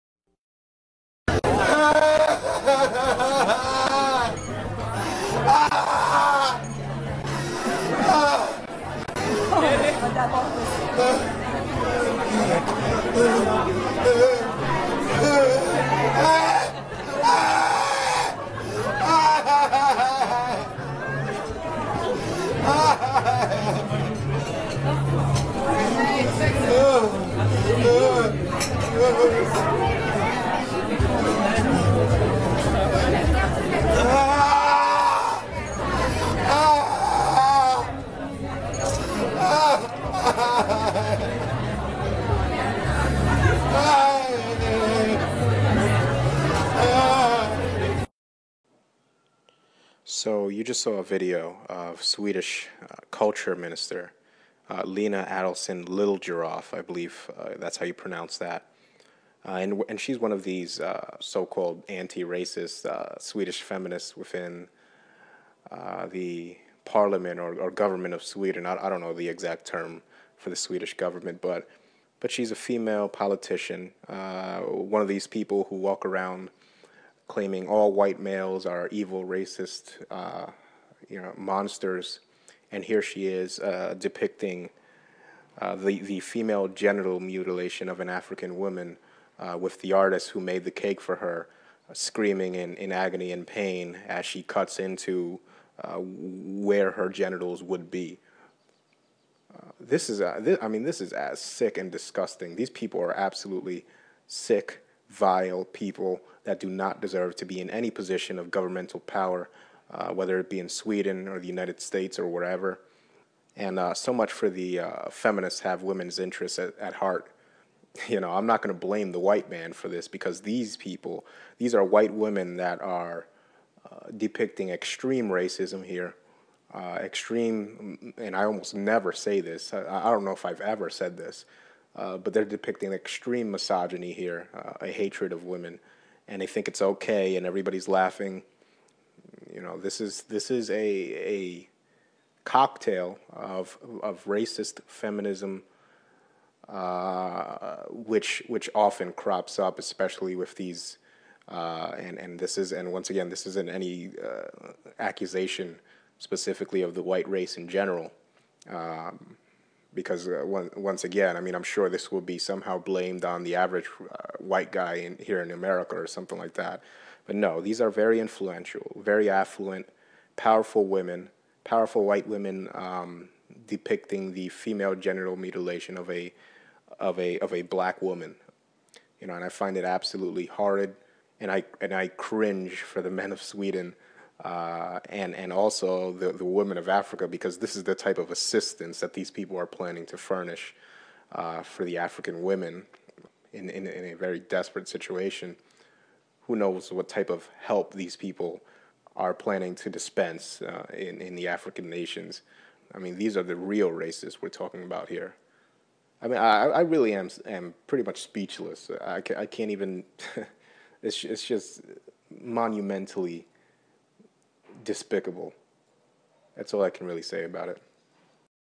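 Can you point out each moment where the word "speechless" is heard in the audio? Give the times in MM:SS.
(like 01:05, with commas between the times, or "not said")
03:28.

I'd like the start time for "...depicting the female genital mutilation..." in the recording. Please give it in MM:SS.
02:53.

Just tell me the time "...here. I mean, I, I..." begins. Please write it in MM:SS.
03:25.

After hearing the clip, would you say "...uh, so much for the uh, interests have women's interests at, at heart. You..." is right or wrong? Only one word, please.
wrong.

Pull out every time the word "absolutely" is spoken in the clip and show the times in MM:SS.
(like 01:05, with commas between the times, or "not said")
01:43, 02:59.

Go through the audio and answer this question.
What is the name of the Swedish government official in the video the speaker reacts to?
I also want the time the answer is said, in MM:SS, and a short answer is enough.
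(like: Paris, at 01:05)
Lena Adelsohn Little, at 00:54.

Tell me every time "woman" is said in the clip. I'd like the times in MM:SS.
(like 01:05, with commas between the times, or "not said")
01:28, 02:58.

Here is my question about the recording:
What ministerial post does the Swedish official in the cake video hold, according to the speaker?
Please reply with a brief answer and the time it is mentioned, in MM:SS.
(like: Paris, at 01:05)
culture minister, at 00:53.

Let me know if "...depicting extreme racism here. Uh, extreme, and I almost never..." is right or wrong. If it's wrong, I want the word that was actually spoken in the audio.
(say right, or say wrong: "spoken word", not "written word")
right.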